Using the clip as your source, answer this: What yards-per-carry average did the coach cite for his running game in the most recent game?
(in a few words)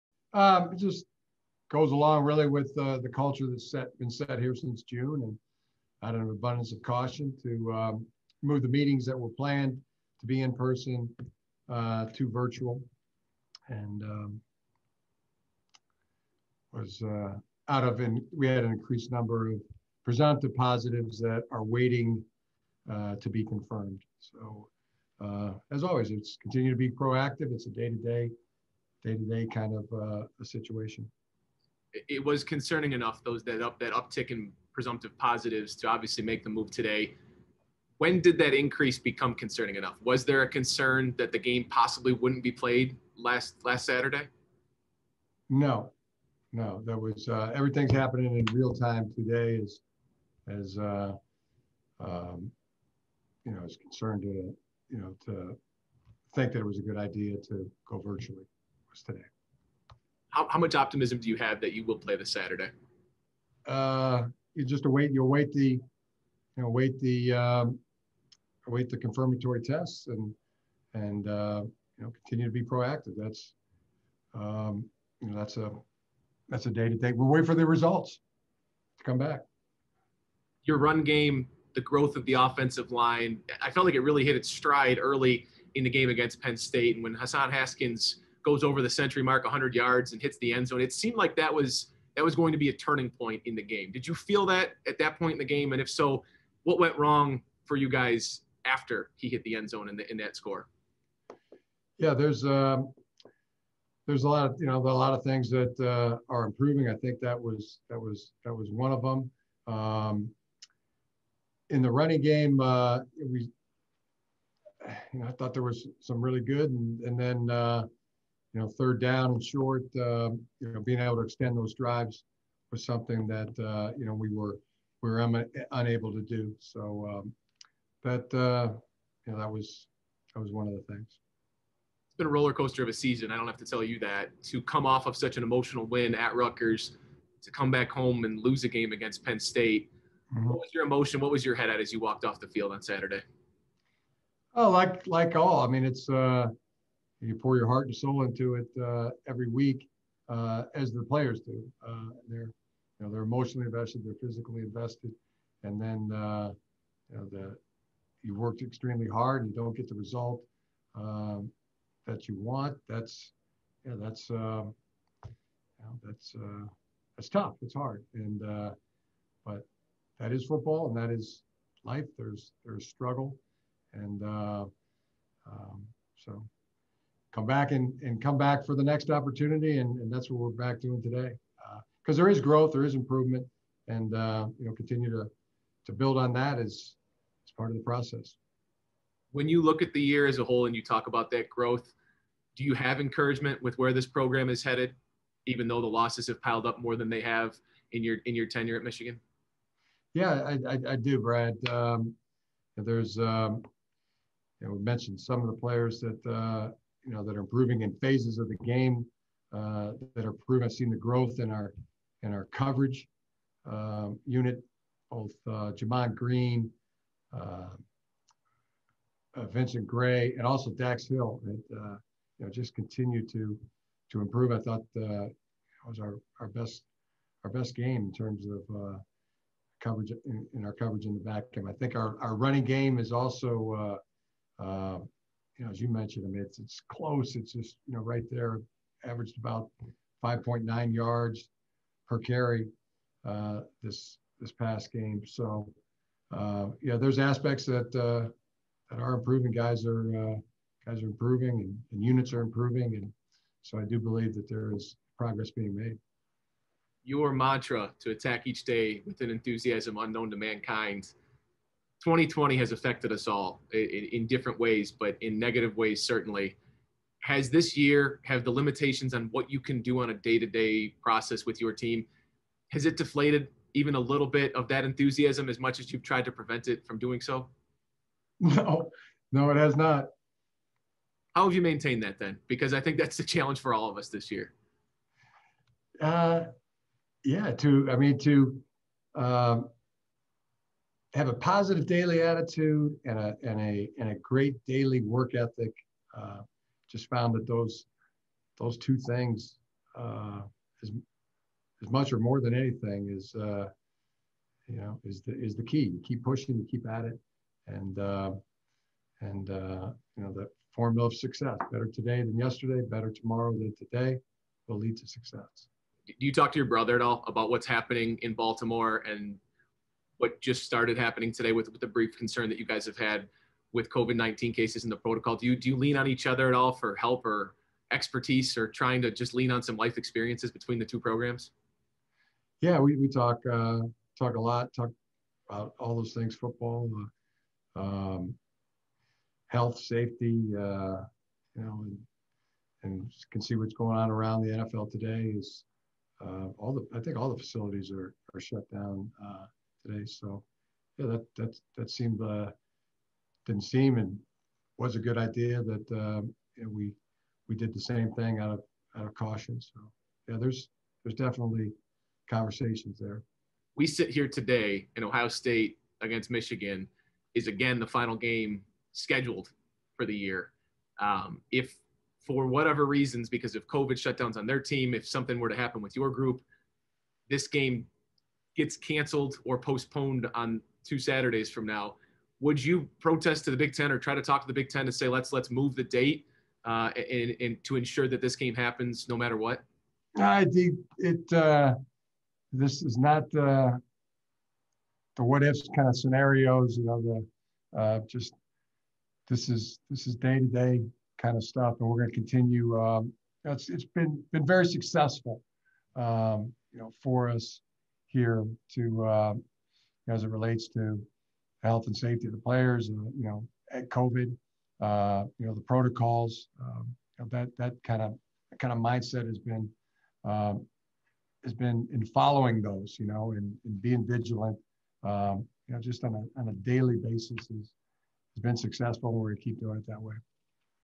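5.9.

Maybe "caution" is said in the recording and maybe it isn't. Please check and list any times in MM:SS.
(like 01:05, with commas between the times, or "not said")
00:06, 05:59.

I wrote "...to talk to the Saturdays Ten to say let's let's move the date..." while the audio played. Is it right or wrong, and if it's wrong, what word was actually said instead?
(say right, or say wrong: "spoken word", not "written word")
wrong: "Big", not "Saturdays".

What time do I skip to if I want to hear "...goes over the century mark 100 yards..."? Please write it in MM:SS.
01:28.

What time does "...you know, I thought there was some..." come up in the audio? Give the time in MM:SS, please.
01:55.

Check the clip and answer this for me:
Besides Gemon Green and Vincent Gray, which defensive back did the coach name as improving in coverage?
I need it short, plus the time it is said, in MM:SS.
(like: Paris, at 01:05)
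Dax Hill, at 03:40.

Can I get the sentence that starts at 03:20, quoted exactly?
Yeah, I, I, I do, Brad.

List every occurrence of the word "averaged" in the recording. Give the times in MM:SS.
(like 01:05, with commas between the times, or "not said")
03:59.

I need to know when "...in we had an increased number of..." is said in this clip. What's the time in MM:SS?
00:17.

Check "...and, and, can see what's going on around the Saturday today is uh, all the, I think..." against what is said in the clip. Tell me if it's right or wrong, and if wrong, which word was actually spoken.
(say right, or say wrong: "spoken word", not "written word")
wrong: "NFL", not "Saturday".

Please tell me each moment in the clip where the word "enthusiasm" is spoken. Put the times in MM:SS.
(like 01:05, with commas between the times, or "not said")
04:19, 04:34.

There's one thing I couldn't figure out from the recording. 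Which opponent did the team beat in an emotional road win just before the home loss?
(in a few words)
Rutgers.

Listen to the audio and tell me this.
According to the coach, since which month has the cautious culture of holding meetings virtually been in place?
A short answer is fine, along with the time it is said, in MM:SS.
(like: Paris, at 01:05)
June, at 00:04.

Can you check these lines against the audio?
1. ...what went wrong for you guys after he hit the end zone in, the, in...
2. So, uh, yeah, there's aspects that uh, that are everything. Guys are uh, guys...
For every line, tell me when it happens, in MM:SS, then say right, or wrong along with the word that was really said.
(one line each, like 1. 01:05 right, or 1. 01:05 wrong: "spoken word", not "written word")
1. 01:36 right
2. 04:05 wrong: "improving", not "everything".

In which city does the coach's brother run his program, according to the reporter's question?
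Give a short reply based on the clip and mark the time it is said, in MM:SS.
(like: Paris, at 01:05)
Baltimore, at 05:18.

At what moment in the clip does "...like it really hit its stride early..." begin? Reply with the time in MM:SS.
01:23.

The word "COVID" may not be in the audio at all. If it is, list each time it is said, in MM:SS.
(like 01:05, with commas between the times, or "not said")
05:23, 06:13, 06:53.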